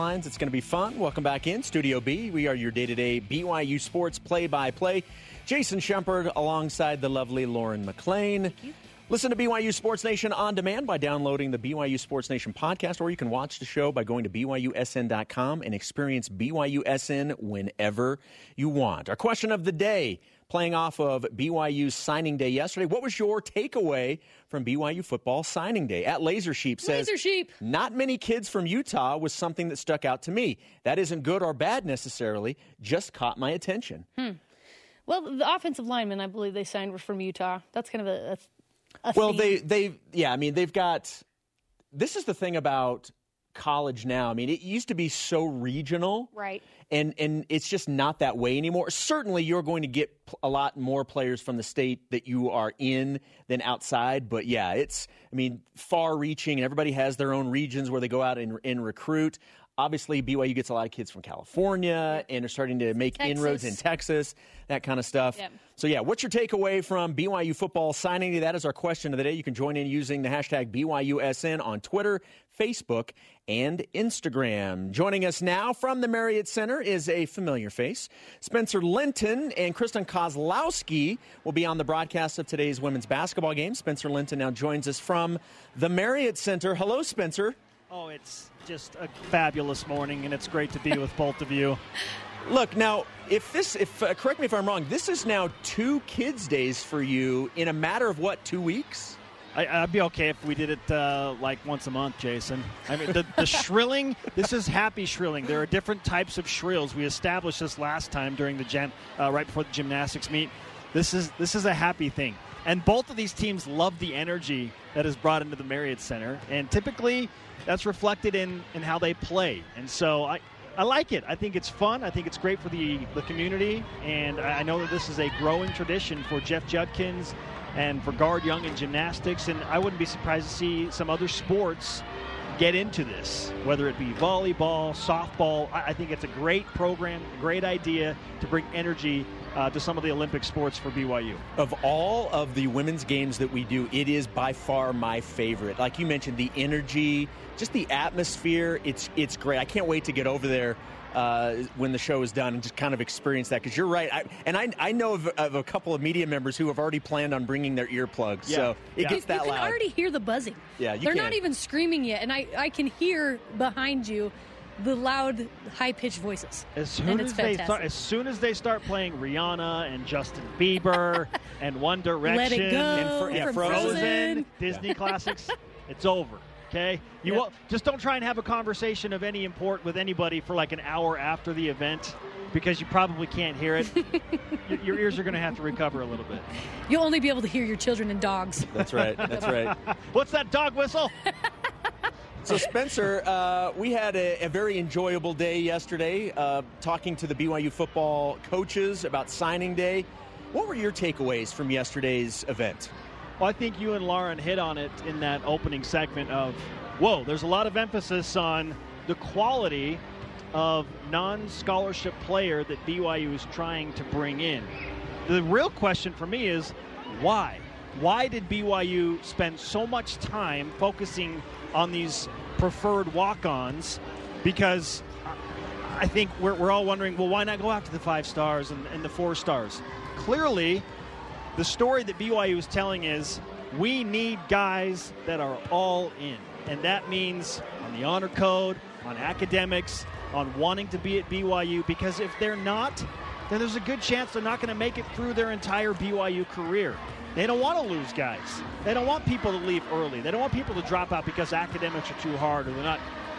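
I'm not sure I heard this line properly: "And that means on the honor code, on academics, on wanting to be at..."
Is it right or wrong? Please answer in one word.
right.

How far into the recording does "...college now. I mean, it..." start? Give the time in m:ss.
0:43.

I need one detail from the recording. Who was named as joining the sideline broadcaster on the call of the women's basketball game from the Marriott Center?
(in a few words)
Kristen Kozlowski.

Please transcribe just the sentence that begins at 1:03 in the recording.
inroads in Texas, that kind of stuff.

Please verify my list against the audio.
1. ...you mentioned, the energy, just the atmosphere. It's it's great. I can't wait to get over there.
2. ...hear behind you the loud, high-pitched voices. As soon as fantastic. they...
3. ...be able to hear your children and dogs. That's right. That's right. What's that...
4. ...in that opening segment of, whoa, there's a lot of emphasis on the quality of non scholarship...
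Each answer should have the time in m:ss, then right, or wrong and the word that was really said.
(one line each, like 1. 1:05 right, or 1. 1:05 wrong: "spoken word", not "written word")
1. 2:25 right
2. 2:42 right
3. 3:07 right
4. 3:25 right.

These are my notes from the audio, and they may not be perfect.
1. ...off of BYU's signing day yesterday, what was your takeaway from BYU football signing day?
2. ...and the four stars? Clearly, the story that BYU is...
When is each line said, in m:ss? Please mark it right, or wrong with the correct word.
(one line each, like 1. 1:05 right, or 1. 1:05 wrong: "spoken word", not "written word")
1. 0:20 right
2. 3:48 right.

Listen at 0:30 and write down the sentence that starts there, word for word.
That isn't good or bad necessarily, just caught my attention.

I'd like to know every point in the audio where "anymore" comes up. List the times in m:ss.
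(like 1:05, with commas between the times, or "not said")
0:48.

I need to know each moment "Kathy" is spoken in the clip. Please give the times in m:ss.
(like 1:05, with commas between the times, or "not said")
not said.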